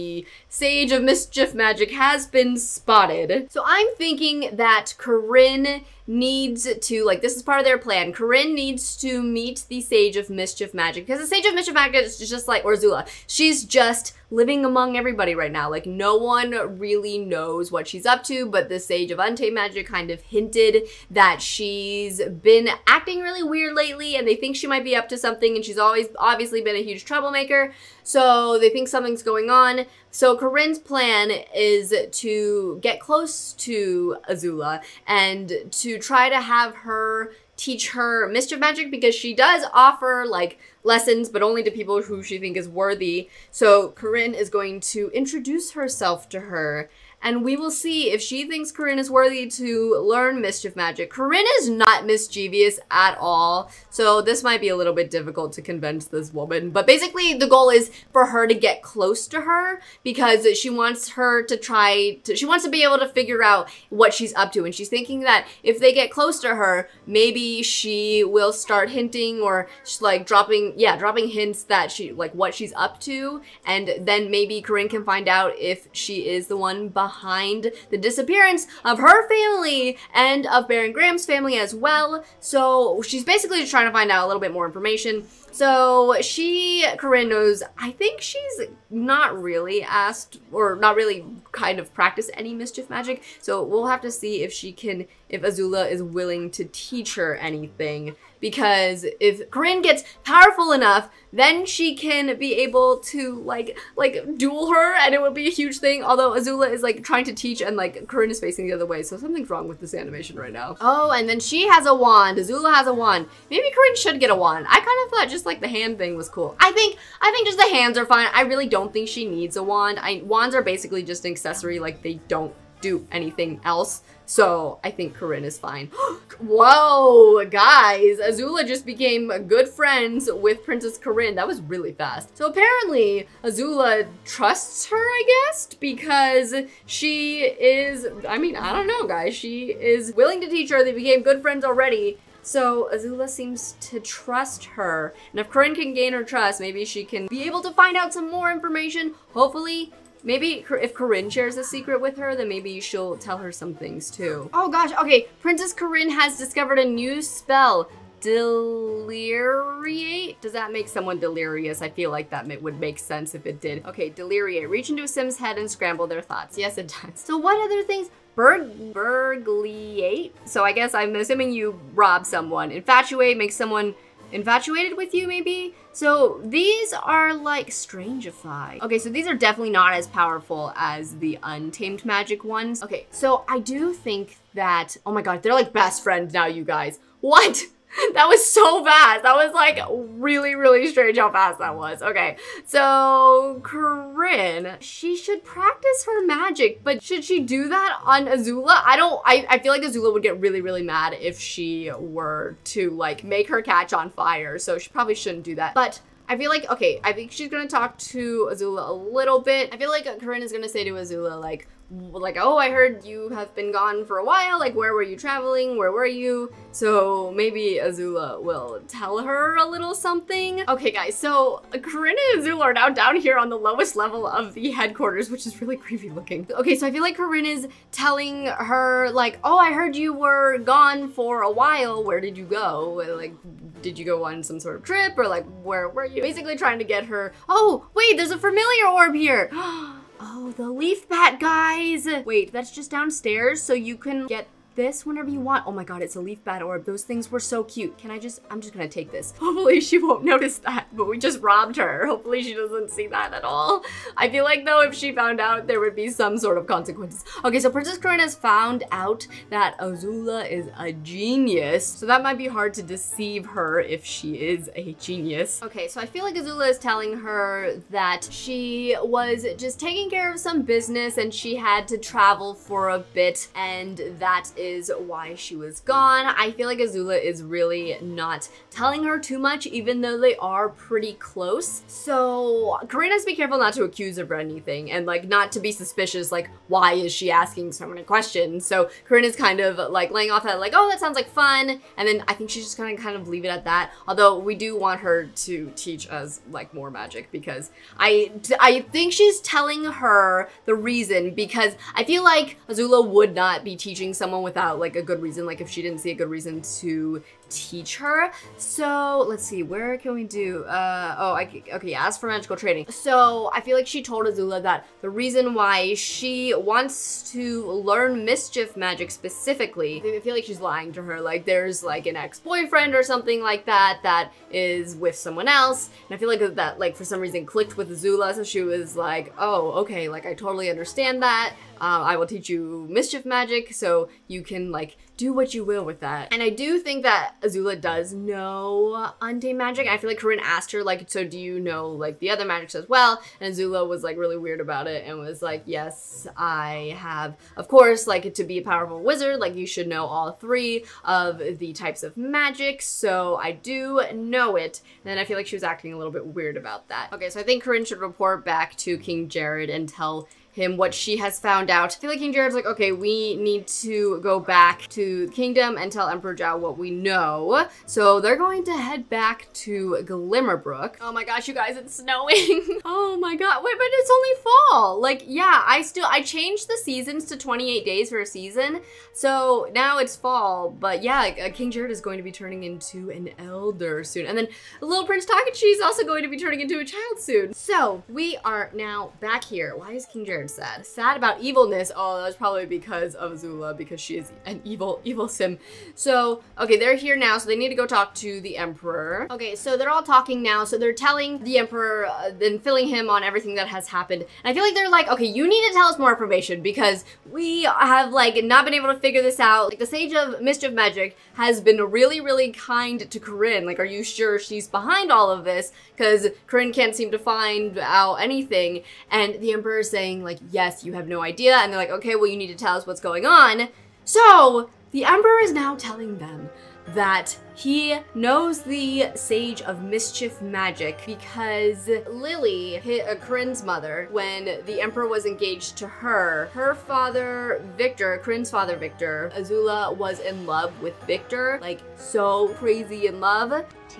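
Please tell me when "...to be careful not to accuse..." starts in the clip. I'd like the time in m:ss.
4:43.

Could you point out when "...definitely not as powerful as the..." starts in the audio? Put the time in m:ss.
2:59.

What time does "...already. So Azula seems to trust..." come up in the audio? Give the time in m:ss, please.
2:21.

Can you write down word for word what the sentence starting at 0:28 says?
So they think something's going on.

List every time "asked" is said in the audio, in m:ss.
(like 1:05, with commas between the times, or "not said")
1:29, 5:40.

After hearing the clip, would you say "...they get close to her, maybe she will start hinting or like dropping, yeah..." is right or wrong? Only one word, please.
right.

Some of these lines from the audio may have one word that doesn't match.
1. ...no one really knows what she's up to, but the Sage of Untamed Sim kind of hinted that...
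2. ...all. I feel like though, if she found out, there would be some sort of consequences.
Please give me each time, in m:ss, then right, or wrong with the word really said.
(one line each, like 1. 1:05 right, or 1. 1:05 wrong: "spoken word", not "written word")
1. 0:15 wrong: "Magic", not "Sim"
2. 4:13 right.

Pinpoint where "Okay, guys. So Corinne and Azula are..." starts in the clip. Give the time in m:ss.
3:40.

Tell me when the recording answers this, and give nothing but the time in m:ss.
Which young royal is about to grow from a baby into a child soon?
6:24.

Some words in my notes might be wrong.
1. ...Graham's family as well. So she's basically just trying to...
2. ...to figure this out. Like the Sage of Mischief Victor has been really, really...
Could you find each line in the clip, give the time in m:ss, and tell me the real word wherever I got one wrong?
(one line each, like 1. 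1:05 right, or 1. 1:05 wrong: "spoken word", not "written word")
1. 1:20 right
2. 6:48 wrong: "Magic", not "Victor".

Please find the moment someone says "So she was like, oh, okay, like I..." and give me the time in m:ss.
5:28.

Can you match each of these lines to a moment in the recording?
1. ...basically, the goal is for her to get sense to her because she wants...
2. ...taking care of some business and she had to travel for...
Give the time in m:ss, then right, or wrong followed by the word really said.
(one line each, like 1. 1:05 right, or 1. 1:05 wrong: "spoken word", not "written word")
1. 0:56 wrong: "close", not "sense"
2. 4:29 right.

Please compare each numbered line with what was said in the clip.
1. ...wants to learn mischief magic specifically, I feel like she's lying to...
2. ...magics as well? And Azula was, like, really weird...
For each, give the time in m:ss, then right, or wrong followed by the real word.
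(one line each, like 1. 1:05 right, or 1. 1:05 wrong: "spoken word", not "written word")
1. 5:16 right
2. 5:42 right.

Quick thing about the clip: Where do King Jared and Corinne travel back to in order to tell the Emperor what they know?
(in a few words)
Glimmerbrook.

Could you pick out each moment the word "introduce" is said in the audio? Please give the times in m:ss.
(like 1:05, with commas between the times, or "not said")
0:45.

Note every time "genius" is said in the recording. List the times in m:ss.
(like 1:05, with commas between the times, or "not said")
4:20, 4:24.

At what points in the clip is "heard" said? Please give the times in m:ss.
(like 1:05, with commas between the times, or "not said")
3:32, 3:49.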